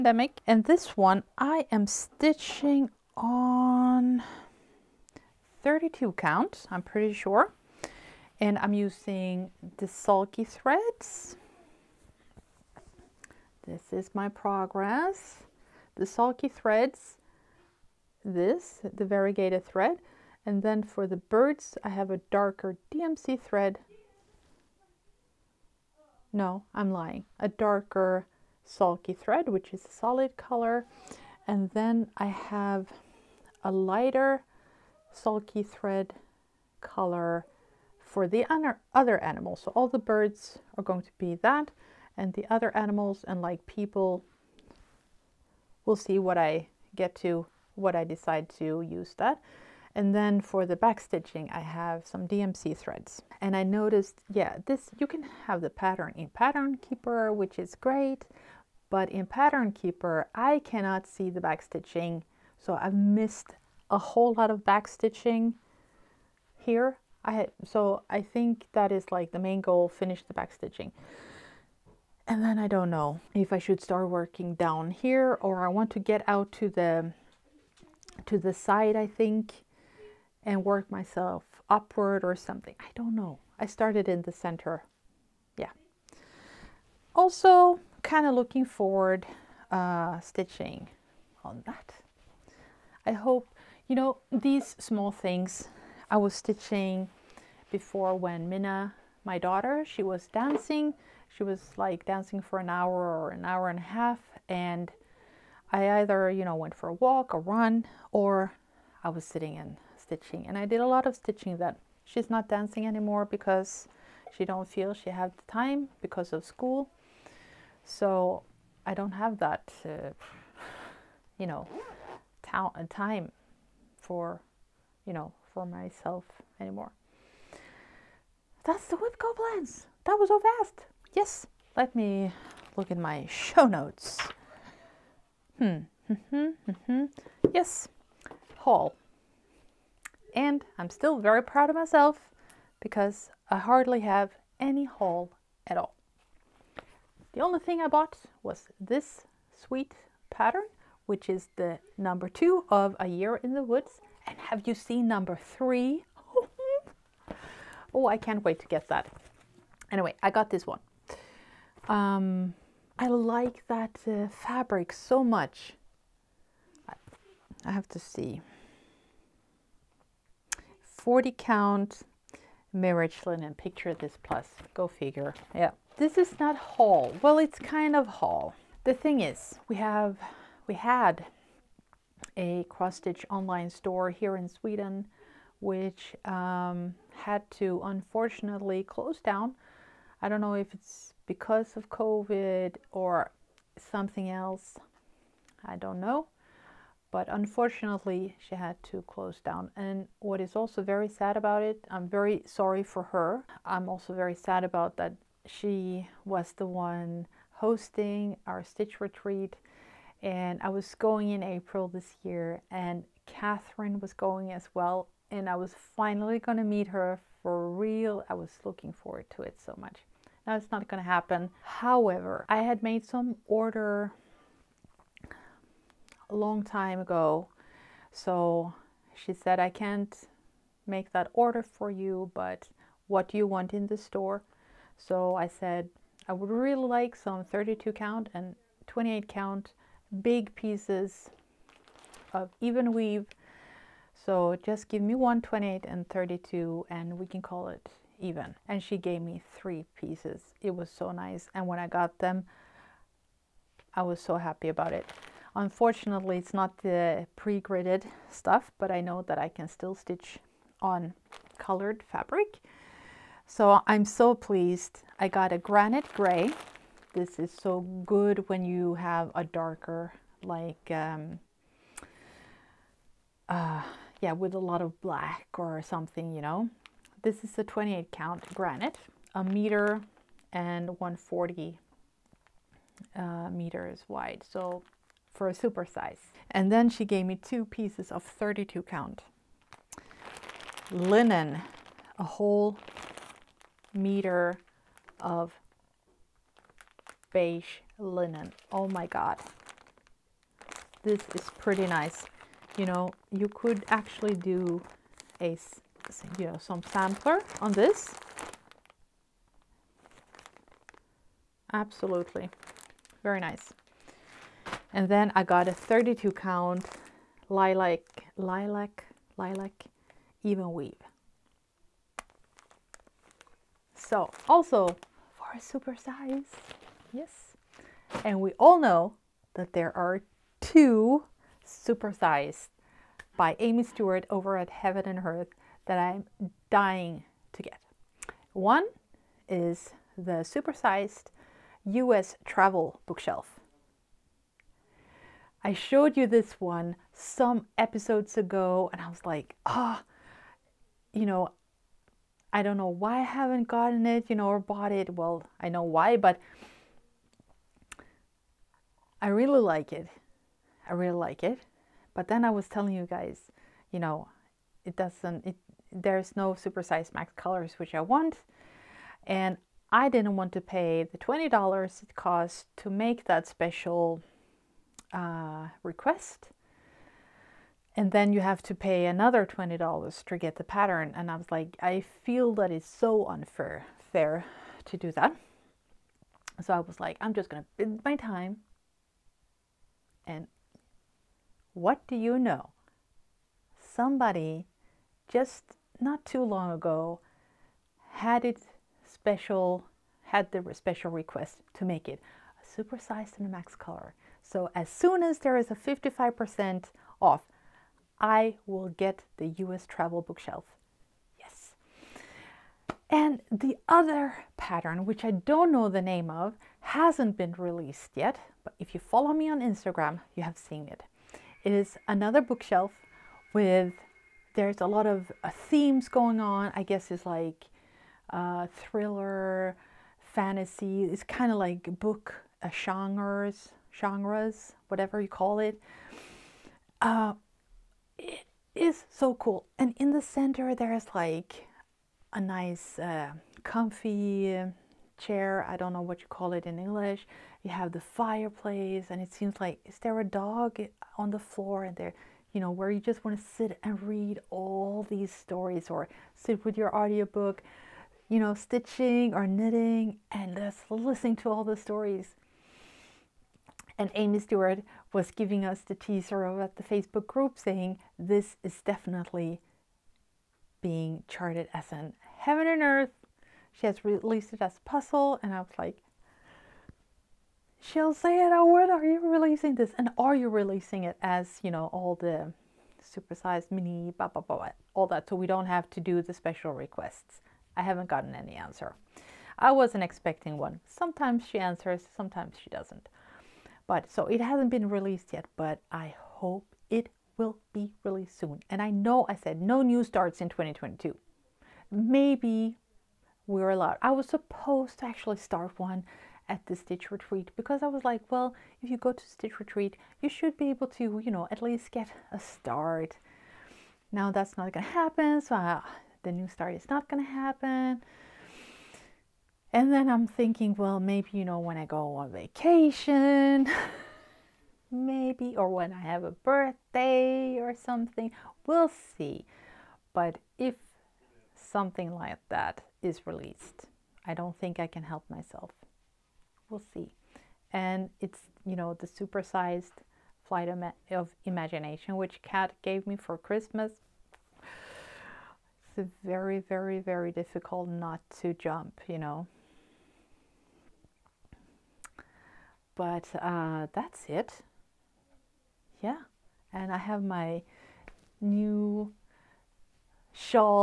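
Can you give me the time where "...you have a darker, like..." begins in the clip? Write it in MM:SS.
04:28.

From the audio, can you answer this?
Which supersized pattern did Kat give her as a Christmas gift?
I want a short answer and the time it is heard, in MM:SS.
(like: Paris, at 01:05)
Flight of Imagination, at 09:00.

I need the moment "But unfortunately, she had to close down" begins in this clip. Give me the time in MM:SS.
03:17.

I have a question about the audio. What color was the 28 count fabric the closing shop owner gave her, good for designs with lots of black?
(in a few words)
Granite gray.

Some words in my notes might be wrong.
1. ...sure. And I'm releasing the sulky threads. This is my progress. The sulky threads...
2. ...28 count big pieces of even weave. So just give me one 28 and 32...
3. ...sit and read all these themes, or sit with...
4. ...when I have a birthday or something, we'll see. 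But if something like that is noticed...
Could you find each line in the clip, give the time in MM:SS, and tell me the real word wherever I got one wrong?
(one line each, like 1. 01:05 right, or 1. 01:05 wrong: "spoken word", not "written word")
1. 00:07 wrong: "using", not "releasing"
2. 03:58 right
3. 07:33 wrong: "stories", not "themes"
4. 08:45 wrong: "released", not "noticed".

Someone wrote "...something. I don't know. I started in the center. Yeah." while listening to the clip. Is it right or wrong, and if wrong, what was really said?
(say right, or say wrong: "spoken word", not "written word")
right.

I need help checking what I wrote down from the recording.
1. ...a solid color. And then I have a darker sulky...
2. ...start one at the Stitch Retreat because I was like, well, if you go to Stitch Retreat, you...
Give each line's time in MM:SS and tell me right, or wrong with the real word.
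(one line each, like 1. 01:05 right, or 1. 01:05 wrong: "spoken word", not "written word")
1. 00:29 wrong: "lighter", not "darker"
2. 08:25 right.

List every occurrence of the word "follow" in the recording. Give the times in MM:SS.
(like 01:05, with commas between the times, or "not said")
06:59.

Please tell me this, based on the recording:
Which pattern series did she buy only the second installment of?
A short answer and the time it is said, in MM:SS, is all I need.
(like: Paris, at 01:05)
A Year in the Woods, at 02:32.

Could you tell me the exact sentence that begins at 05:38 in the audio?
One is the supersized US travel bookshelf.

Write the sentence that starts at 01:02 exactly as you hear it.
So I've missed a whole lot of back stitching here.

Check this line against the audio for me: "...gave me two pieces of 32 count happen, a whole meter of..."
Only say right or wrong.
wrong.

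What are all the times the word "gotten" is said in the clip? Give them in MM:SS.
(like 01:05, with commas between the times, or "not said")
05:53, 08:08.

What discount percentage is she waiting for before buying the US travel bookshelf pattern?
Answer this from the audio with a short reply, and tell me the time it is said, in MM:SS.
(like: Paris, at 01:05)
55%, at 06:45.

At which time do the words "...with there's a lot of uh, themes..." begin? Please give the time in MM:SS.
07:03.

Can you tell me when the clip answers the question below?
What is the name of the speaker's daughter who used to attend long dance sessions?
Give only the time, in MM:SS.
01:38.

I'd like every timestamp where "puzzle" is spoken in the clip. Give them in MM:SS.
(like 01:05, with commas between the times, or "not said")
07:54.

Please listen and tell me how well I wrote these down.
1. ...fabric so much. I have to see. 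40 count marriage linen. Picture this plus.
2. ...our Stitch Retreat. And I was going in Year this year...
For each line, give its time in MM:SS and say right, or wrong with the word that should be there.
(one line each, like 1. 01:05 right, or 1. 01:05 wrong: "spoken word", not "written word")
1. 02:44 right
2. 03:28 wrong: "April", not "Year".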